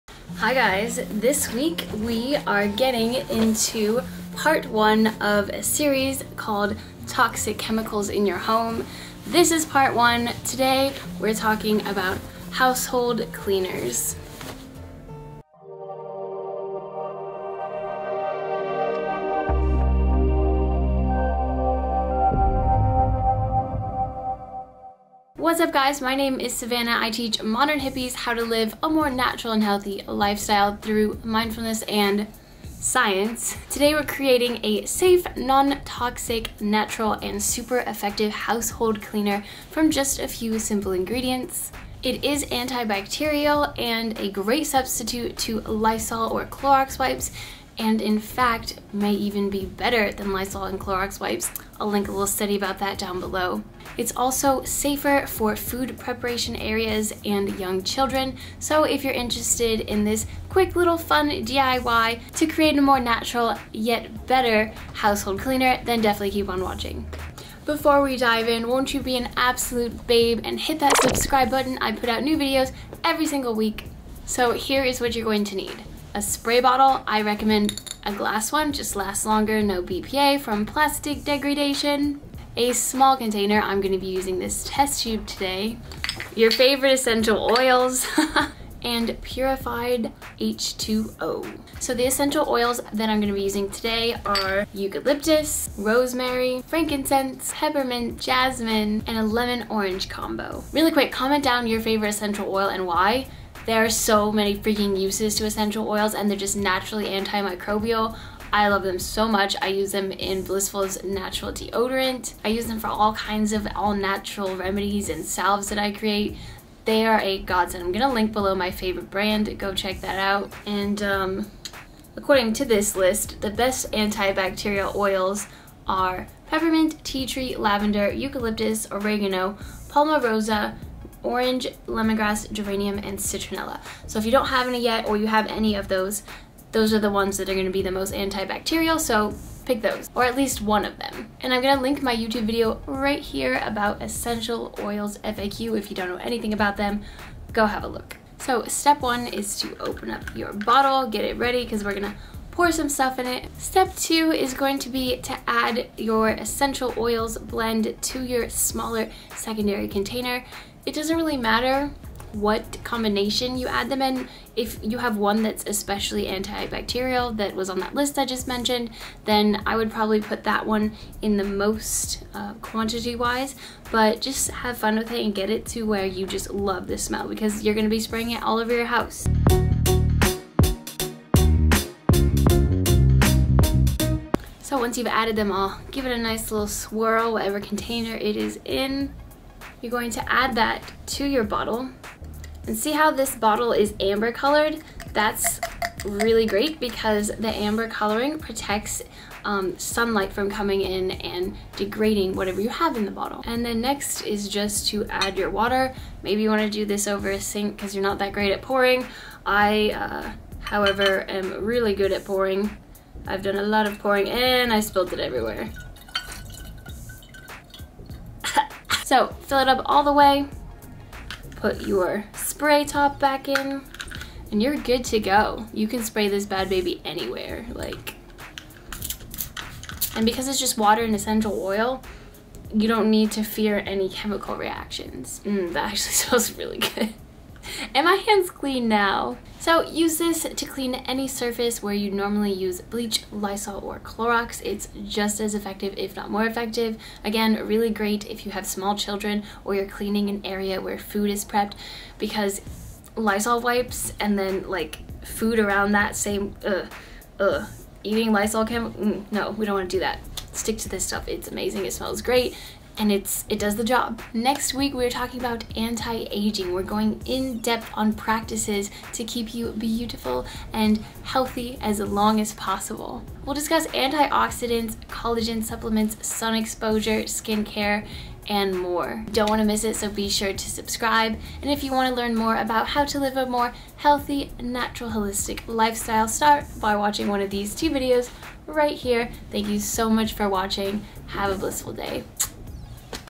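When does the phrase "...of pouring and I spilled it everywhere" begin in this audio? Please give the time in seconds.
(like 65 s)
213 s.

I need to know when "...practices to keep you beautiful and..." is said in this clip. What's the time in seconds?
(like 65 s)
268 s.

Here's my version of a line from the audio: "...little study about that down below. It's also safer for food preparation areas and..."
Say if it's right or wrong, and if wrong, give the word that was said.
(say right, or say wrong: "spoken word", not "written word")
right.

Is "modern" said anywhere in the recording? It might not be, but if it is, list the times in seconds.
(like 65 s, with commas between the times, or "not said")
27 s.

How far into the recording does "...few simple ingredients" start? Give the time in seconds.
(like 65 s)
40 s.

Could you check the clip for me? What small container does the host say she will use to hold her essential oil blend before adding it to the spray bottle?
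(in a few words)
test tube.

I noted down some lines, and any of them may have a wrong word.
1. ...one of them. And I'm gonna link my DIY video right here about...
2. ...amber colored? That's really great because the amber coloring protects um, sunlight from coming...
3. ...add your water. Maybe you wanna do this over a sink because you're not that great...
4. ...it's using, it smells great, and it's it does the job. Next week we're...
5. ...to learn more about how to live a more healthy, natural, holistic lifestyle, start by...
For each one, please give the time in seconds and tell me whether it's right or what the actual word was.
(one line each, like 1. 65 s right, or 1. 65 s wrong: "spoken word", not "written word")
1. 140 s wrong: "YouTube", not "DIY"
2. 193 s right
3. 205 s right
4. 261 s wrong: "amazing", not "using"
5. 282 s right.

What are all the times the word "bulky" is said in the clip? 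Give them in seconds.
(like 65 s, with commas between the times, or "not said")
not said.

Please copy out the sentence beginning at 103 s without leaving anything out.
There are so many freaking uses to essential oils and they're just naturally antimicrobial.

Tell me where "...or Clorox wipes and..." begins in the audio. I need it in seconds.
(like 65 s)
46 s.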